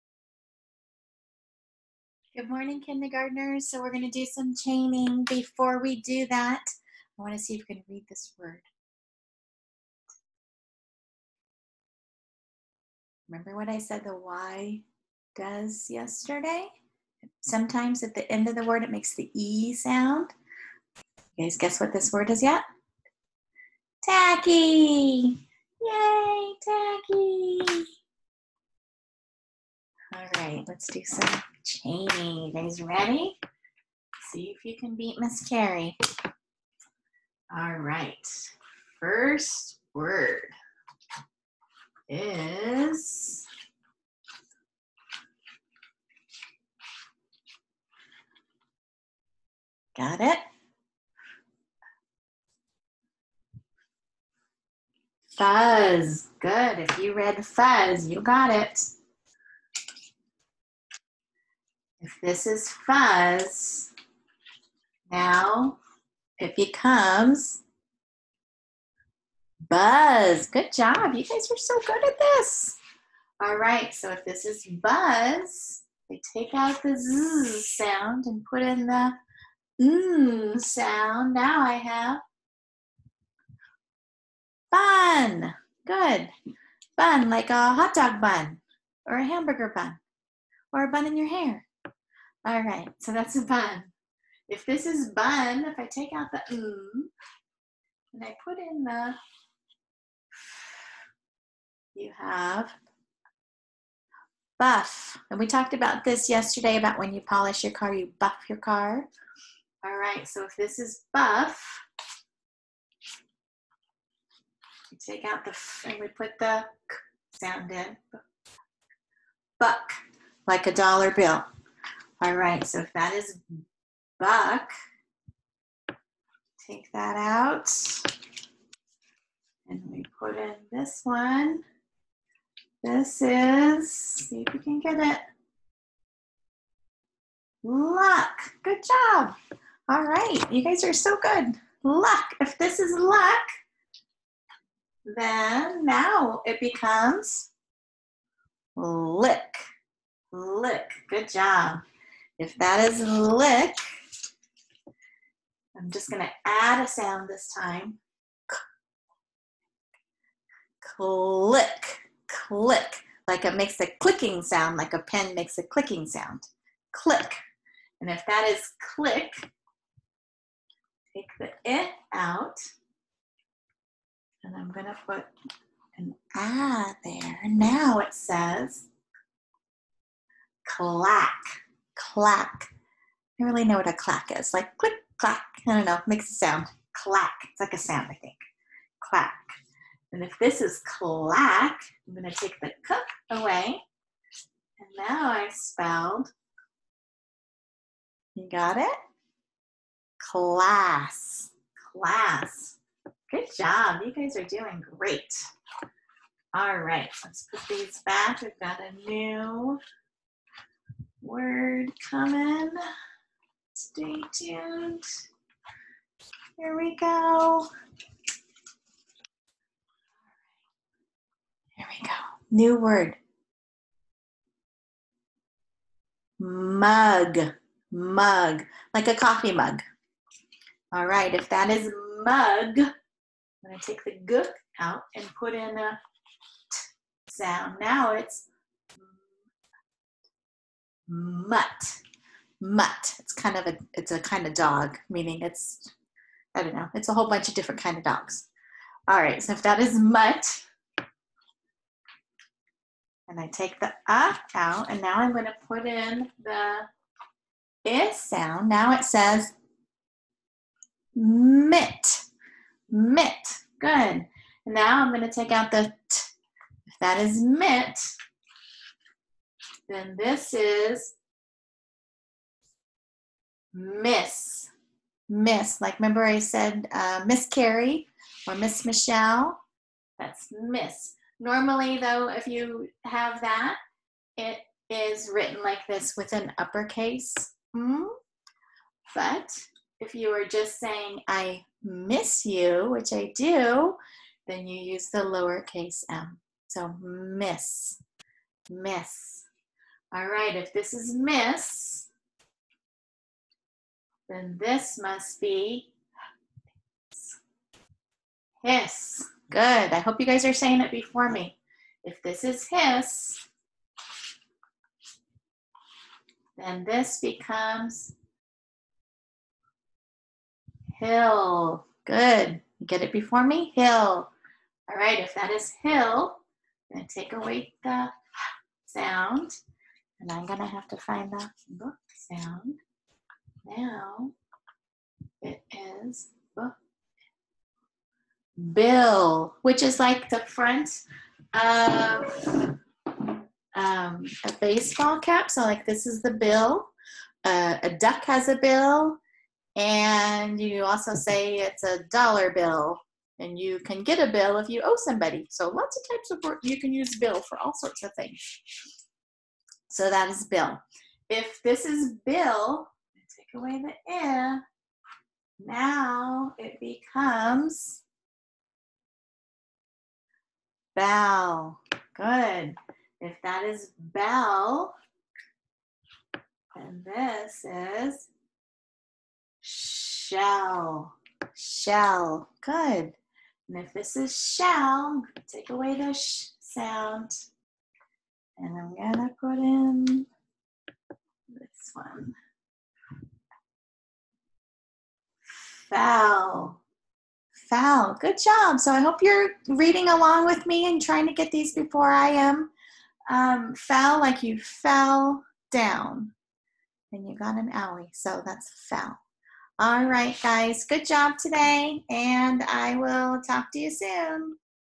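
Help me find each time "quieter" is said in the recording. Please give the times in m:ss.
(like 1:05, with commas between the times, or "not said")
not said.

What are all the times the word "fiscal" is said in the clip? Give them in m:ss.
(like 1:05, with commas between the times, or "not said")
not said.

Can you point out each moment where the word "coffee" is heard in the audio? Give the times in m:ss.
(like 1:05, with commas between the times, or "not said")
3:49.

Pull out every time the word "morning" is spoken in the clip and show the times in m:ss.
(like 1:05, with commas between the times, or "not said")
0:02.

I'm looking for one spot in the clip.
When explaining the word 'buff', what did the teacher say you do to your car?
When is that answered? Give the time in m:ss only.
1:47.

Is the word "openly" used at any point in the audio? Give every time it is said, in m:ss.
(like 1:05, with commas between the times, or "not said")
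not said.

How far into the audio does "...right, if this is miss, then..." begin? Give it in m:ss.
5:00.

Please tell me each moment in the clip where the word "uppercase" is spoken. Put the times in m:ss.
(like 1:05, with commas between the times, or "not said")
4:46.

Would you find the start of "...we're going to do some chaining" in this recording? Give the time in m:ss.
0:03.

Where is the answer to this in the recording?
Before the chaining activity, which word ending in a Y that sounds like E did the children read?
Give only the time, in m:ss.
0:24.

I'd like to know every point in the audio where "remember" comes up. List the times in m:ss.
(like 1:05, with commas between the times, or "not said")
0:13, 4:35.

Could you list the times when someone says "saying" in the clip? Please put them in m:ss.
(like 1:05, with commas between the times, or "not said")
4:50, 5:10.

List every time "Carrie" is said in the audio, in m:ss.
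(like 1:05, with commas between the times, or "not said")
0:35, 4:37.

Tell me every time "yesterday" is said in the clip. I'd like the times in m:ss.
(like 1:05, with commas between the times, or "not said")
0:15, 1:46.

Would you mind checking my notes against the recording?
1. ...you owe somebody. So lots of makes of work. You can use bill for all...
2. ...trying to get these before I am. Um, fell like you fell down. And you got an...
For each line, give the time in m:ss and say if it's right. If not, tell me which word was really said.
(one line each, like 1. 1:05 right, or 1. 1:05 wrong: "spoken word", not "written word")
1. 5:54 wrong: "types", not "makes"
2. 6:41 right.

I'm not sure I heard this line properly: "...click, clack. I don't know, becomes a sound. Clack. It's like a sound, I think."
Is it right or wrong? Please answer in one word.
wrong.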